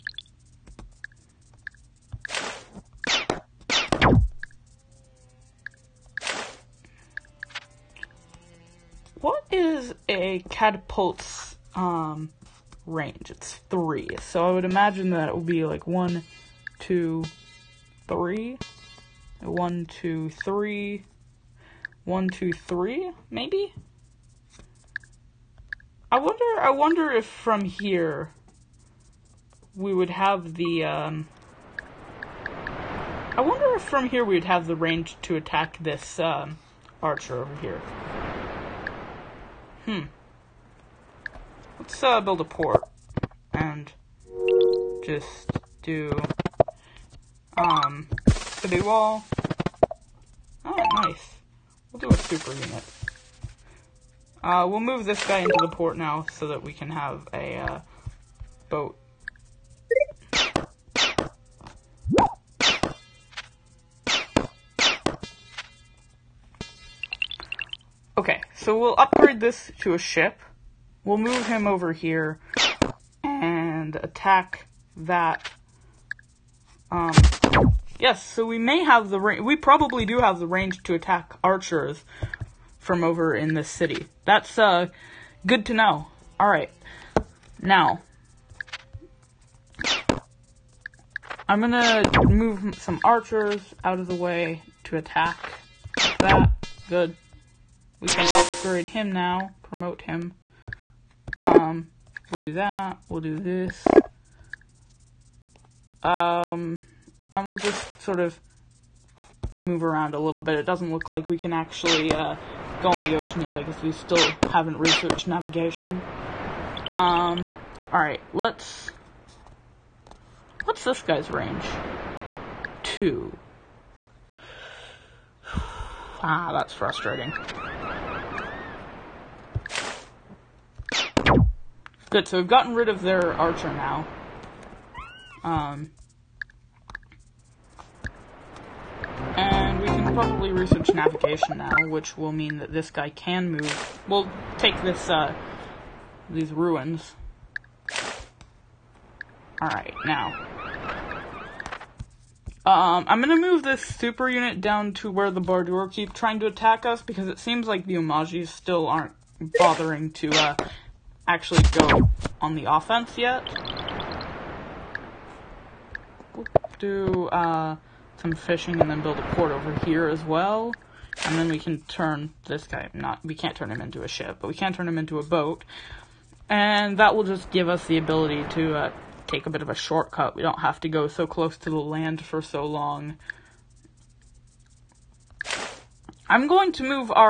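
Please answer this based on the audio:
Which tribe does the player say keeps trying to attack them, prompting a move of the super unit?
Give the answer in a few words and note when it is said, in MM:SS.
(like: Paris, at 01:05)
Bardur, at 02:35.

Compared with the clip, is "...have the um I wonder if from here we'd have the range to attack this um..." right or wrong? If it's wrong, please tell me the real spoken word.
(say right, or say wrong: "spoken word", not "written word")
right.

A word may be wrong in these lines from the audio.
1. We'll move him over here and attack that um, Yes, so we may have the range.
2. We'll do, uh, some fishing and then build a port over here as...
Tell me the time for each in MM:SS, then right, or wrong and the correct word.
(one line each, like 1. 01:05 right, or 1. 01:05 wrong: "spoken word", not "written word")
1. 01:11 right
2. 02:46 right.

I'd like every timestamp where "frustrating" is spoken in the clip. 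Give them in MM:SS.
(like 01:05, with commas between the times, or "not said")
02:06.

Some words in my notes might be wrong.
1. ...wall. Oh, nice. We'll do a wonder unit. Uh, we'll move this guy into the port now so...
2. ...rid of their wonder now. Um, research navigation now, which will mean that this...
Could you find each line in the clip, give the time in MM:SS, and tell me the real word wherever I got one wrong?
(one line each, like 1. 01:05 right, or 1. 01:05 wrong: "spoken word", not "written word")
1. 00:48 wrong: "super", not "wonder"
2. 02:12 wrong: "archer", not "wonder".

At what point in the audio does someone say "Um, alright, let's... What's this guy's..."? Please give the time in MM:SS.
01:56.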